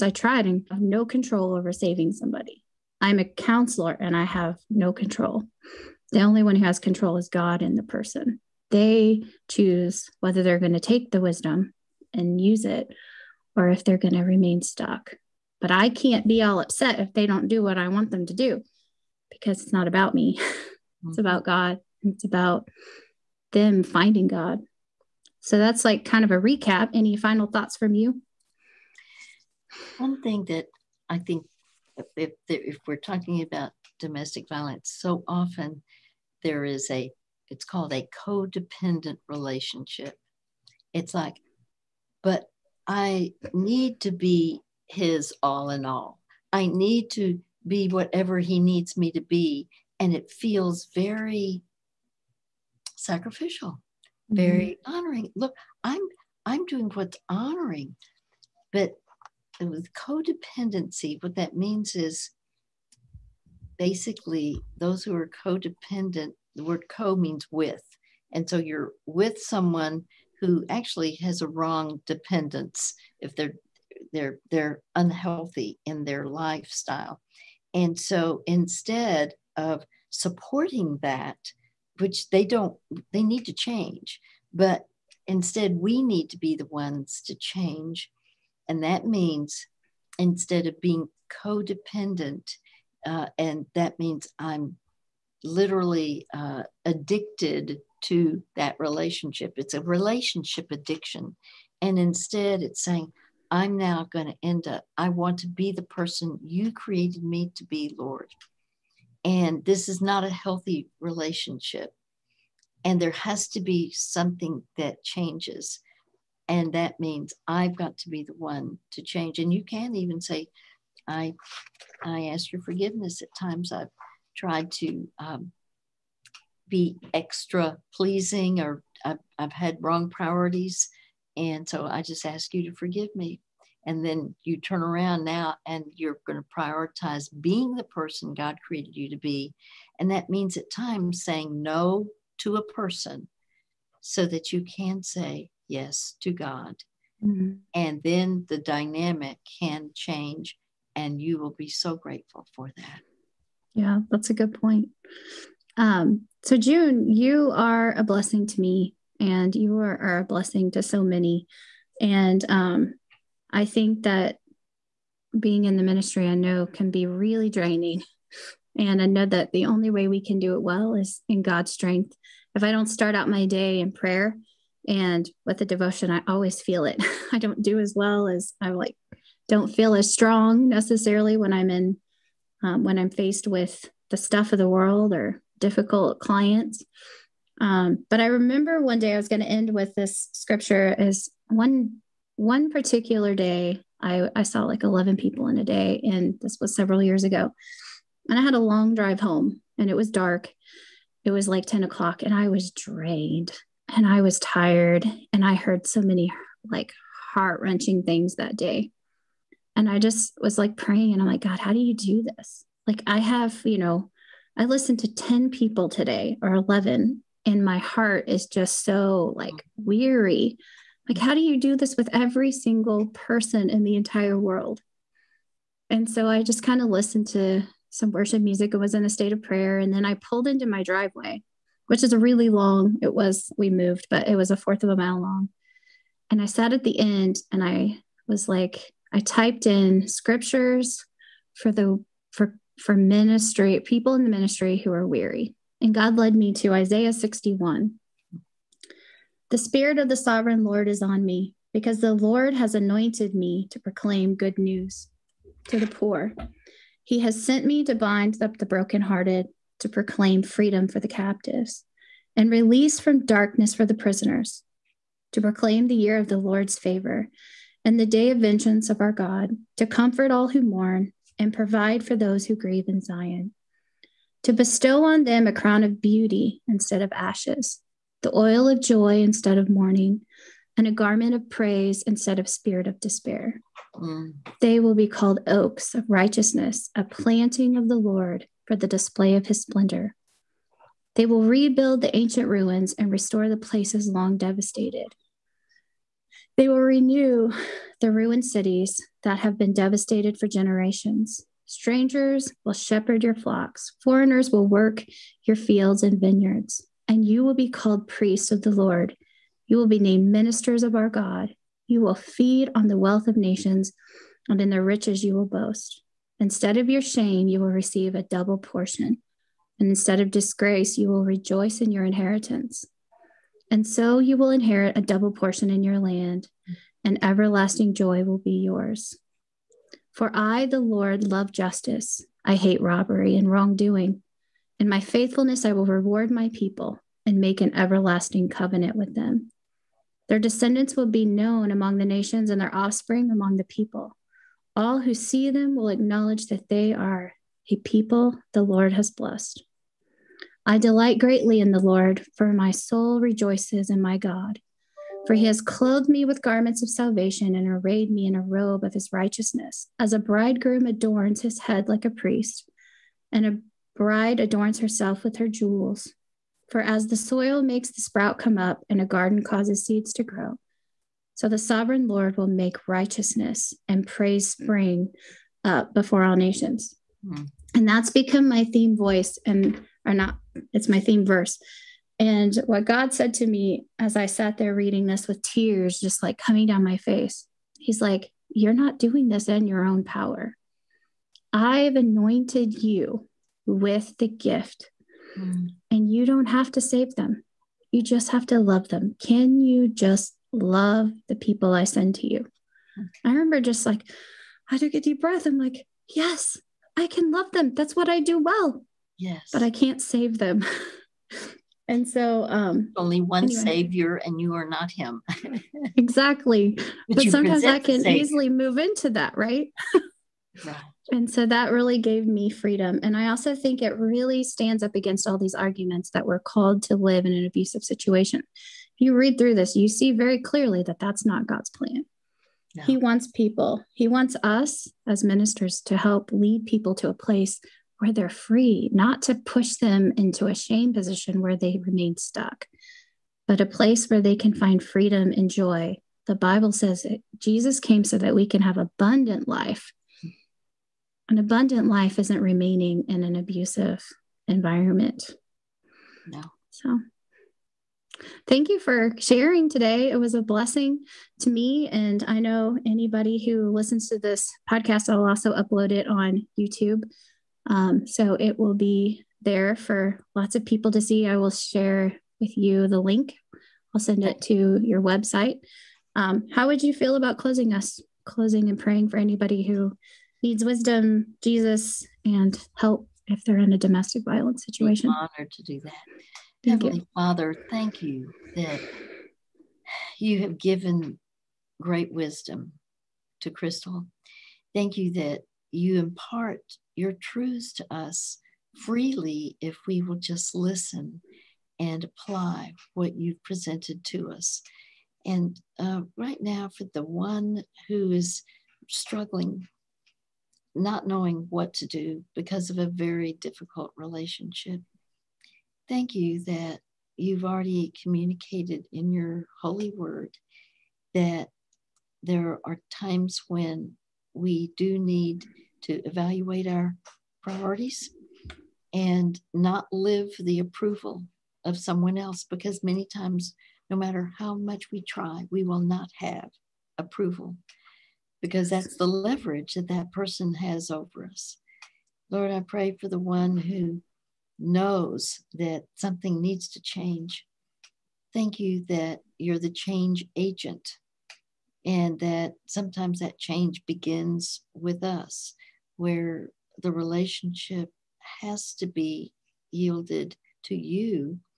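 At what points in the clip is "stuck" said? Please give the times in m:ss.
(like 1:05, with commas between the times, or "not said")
0:14, 7:22.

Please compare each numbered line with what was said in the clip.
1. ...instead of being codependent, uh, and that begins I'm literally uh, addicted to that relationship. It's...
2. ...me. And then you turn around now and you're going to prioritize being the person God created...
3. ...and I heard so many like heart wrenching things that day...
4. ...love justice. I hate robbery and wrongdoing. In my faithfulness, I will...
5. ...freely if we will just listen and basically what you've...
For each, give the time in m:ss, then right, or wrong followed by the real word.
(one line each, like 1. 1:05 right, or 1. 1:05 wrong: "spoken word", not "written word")
1. 1:30 wrong: "means", not "begins"
2. 2:13 right
3. 3:25 right
4. 5:31 right
5. 8:18 wrong: "apply", not "basically".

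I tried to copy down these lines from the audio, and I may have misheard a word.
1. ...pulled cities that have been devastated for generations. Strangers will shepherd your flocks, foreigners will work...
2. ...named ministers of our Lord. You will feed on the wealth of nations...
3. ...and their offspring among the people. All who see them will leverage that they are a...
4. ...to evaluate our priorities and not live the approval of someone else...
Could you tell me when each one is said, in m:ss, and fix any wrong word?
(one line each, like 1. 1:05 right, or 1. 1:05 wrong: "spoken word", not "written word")
1. 4:58 wrong: "ruined", not "pulled"
2. 5:09 wrong: "God", not "Lord"
3. 5:42 wrong: "acknowledge", not "leverage"
4. 8:45 right.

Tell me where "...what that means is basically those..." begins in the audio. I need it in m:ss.
1:01.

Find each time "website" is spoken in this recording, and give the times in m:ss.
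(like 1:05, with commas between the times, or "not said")
7:55.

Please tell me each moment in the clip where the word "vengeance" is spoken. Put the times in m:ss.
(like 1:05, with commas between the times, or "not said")
4:28.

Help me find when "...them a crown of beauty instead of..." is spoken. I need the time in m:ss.
4:35.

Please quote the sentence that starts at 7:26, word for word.
The Bible says that Jesus came so that we can have abundant life.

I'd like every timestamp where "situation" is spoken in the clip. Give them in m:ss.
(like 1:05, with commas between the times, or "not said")
7:07, 8:04.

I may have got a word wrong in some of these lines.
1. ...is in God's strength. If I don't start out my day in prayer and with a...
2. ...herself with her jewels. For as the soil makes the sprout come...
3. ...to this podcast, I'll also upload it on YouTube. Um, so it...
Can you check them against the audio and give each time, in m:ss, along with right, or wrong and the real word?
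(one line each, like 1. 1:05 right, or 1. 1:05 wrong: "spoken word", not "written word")
1. 2:50 right
2. 6:04 right
3. 7:44 right.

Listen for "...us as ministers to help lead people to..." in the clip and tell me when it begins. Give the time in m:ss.
7:14.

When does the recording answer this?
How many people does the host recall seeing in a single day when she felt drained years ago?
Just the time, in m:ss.
3:14.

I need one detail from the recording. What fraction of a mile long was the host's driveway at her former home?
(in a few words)
a fourth.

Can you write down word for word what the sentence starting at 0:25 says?
So that's like kind of a recap.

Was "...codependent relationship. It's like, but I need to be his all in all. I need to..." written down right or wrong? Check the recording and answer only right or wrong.
right.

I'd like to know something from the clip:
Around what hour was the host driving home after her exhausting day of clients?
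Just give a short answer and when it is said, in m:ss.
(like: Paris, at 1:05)
10 o'clock, at 3:21.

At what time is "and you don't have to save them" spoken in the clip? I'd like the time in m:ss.
6:35.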